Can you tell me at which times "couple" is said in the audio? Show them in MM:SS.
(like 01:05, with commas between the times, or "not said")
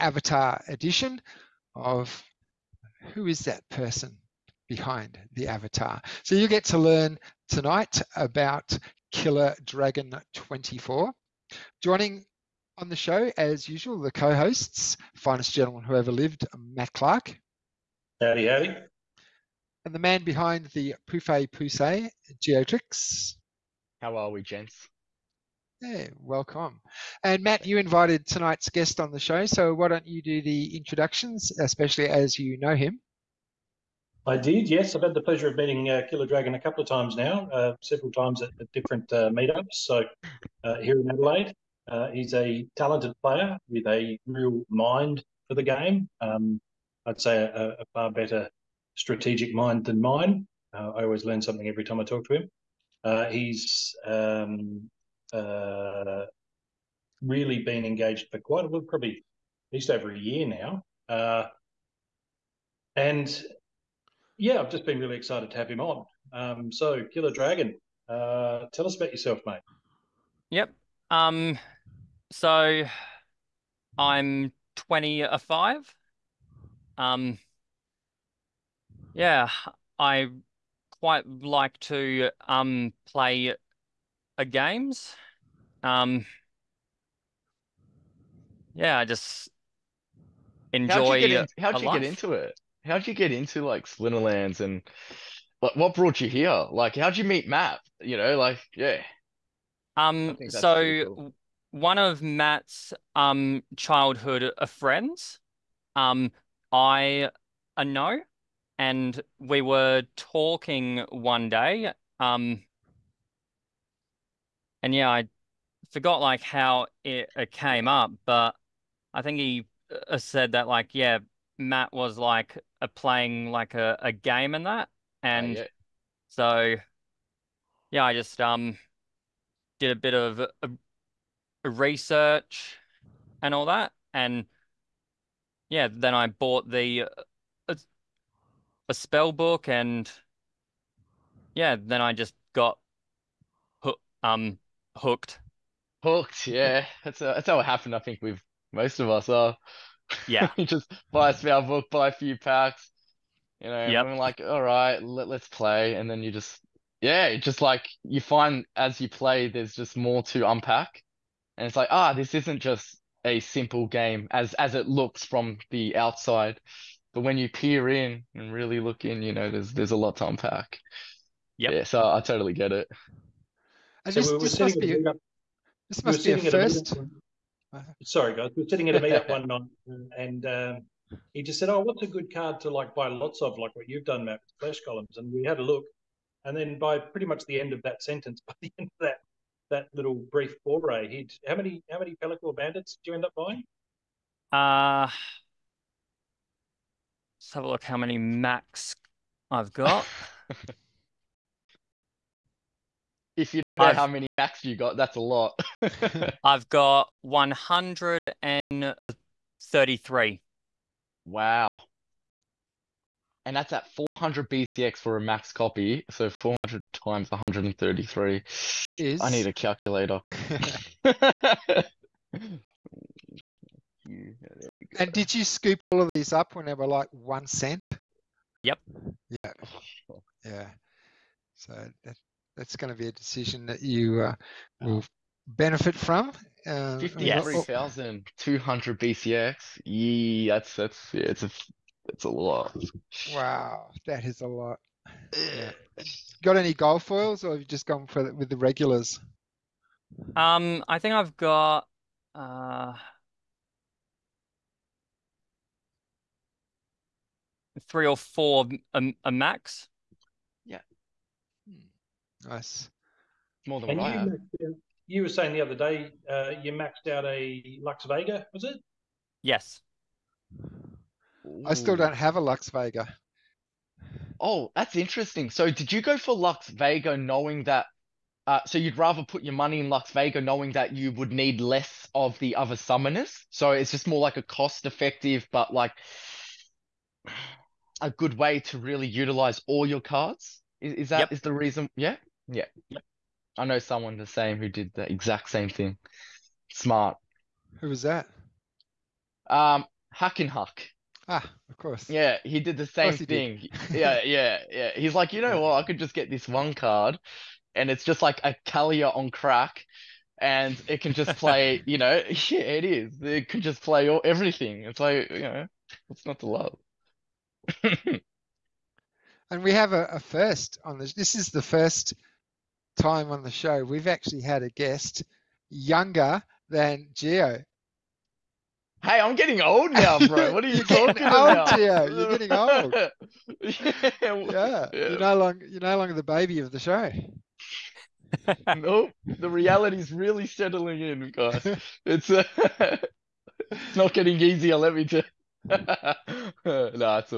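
00:36.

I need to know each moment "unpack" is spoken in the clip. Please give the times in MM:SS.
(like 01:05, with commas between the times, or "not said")
02:40, 02:50.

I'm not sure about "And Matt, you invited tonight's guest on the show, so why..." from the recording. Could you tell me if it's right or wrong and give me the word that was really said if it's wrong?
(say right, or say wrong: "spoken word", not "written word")
right.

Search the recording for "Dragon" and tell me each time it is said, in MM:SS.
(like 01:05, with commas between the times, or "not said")
00:09, 00:36, 01:07.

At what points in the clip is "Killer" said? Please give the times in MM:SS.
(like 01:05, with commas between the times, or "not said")
00:09, 00:36, 01:07.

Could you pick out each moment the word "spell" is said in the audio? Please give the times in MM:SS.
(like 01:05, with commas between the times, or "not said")
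02:18, 02:31.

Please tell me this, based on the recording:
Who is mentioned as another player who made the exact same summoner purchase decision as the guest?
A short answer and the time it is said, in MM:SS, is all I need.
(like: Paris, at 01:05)
Huck, at 05:00.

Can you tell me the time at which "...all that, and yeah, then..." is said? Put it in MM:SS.
02:13.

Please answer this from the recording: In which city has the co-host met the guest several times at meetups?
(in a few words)
Adelaide.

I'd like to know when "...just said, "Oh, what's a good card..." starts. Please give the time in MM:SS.
03:01.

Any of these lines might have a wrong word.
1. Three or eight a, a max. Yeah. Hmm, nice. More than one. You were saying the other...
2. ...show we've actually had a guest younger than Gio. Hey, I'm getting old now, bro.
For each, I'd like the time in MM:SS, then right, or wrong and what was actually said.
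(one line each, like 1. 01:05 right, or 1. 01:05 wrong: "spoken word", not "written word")
1. 04:17 wrong: "four", not "eight"
2. 05:23 right.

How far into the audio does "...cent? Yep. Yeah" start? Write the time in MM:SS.
03:47.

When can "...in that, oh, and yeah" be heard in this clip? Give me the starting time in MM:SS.
02:04.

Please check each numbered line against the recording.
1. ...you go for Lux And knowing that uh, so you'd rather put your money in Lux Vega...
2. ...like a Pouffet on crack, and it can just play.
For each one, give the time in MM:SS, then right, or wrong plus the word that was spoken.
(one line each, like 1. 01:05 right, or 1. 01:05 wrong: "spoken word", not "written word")
1. 04:35 wrong: "Vega", not "And"
2. 05:08 wrong: "Kalia", not "Pouffet".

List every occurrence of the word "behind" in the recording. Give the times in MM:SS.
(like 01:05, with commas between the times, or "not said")
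00:04, 00:20.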